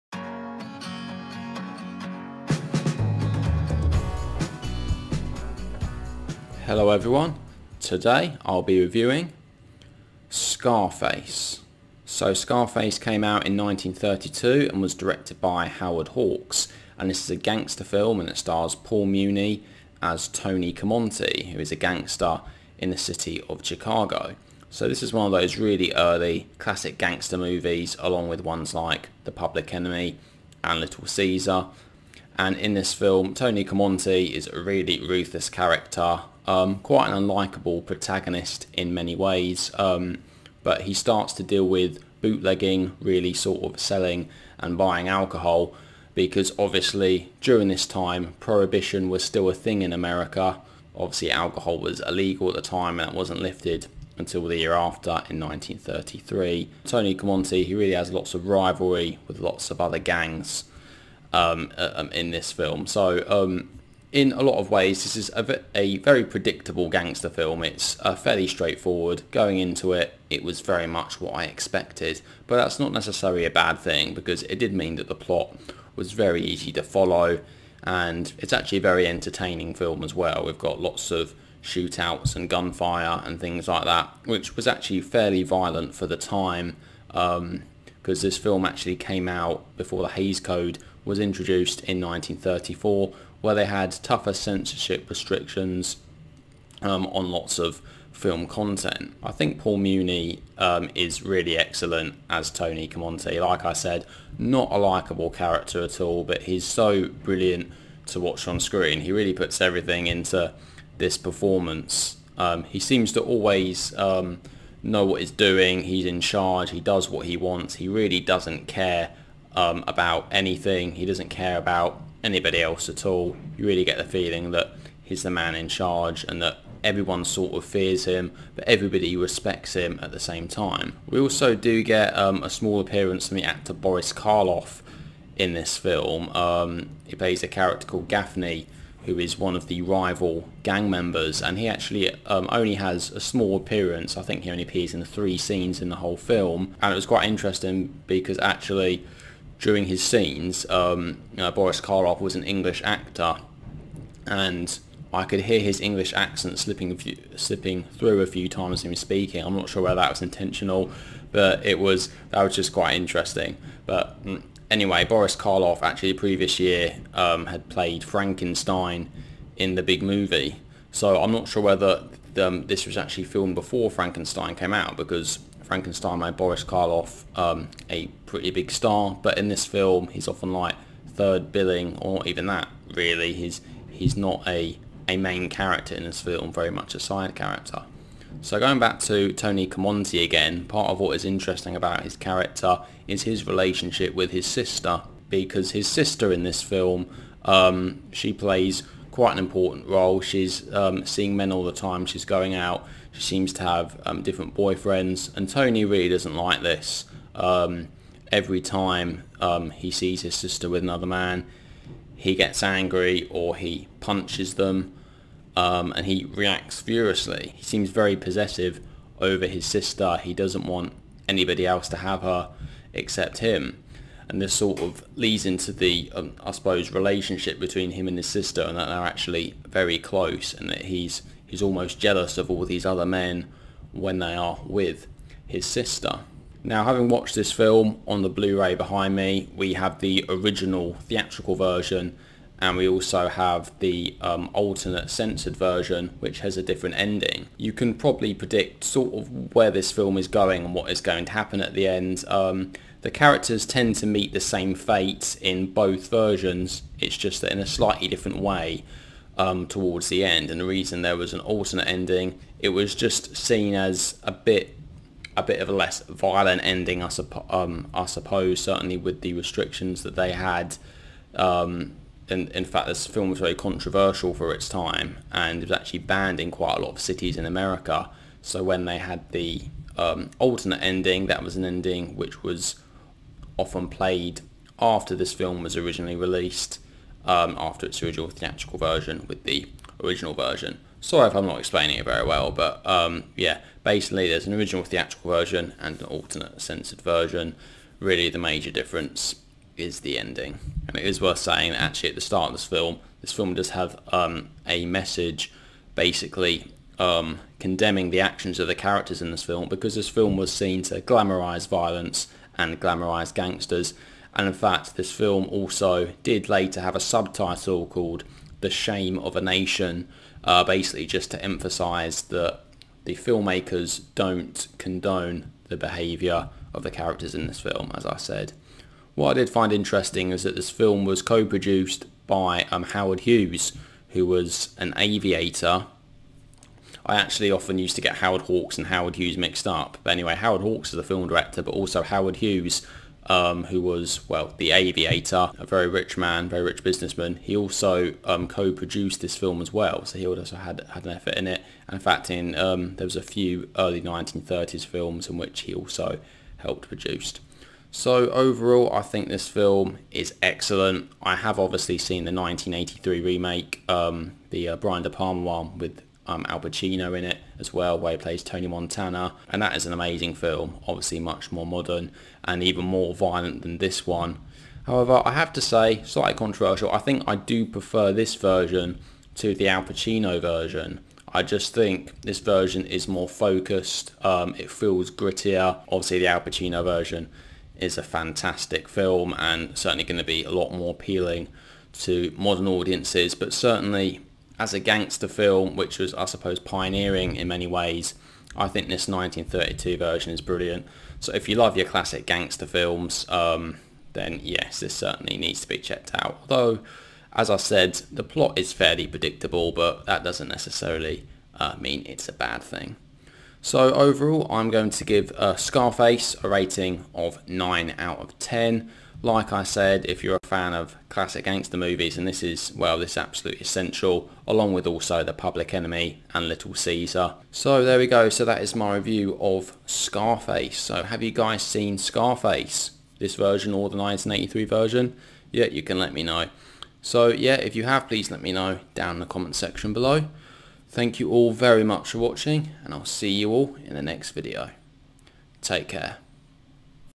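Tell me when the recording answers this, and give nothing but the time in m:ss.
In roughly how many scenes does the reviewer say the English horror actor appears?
2:25.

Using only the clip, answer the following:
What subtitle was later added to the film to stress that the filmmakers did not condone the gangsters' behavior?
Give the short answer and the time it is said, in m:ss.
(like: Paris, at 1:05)
The Shame of a Nation, at 5:18.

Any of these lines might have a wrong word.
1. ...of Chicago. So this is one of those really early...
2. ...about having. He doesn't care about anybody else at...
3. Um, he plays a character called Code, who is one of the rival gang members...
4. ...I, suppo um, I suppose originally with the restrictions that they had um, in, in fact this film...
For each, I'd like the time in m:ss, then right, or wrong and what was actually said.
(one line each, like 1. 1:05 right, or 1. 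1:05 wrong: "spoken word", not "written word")
1. 0:23 right
2. 1:59 wrong: "anything", not "having"
3. 2:16 wrong: "Gaffney", not "Code"
4. 4:27 wrong: "certainly", not "originally".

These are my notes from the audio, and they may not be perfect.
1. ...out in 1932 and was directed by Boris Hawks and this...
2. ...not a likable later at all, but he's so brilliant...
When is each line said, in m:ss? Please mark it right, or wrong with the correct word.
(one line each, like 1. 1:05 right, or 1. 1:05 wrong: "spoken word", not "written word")
1. 0:13 wrong: "Howard", not "Boris"
2. 1:44 wrong: "character", not "later".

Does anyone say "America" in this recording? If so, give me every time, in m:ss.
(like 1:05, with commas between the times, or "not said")
0:49, 4:37.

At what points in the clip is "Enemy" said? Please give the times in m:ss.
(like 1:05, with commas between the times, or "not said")
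0:29, 7:05.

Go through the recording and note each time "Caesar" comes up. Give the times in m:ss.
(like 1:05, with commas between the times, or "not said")
0:31, 7:06.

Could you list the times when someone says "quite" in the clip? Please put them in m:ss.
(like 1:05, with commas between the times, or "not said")
0:36, 2:27, 2:42, 3:19, 4:36.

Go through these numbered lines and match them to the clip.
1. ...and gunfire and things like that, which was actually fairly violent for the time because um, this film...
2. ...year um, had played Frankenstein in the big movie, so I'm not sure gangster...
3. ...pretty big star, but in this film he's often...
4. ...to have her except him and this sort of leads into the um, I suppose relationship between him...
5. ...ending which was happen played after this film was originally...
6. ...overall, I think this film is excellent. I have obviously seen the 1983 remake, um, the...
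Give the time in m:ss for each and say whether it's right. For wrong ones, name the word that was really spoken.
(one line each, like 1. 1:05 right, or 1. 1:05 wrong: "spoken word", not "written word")
1. 1:22 right
2. 2:46 wrong: "whether", not "gangster"
3. 2:58 right
4. 3:41 right
5. 4:41 wrong: "often", not "happen"
6. 5:58 right.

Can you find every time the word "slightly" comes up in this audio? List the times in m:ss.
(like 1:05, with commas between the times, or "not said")
4:17, 6:16.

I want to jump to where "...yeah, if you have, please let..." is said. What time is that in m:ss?
7:17.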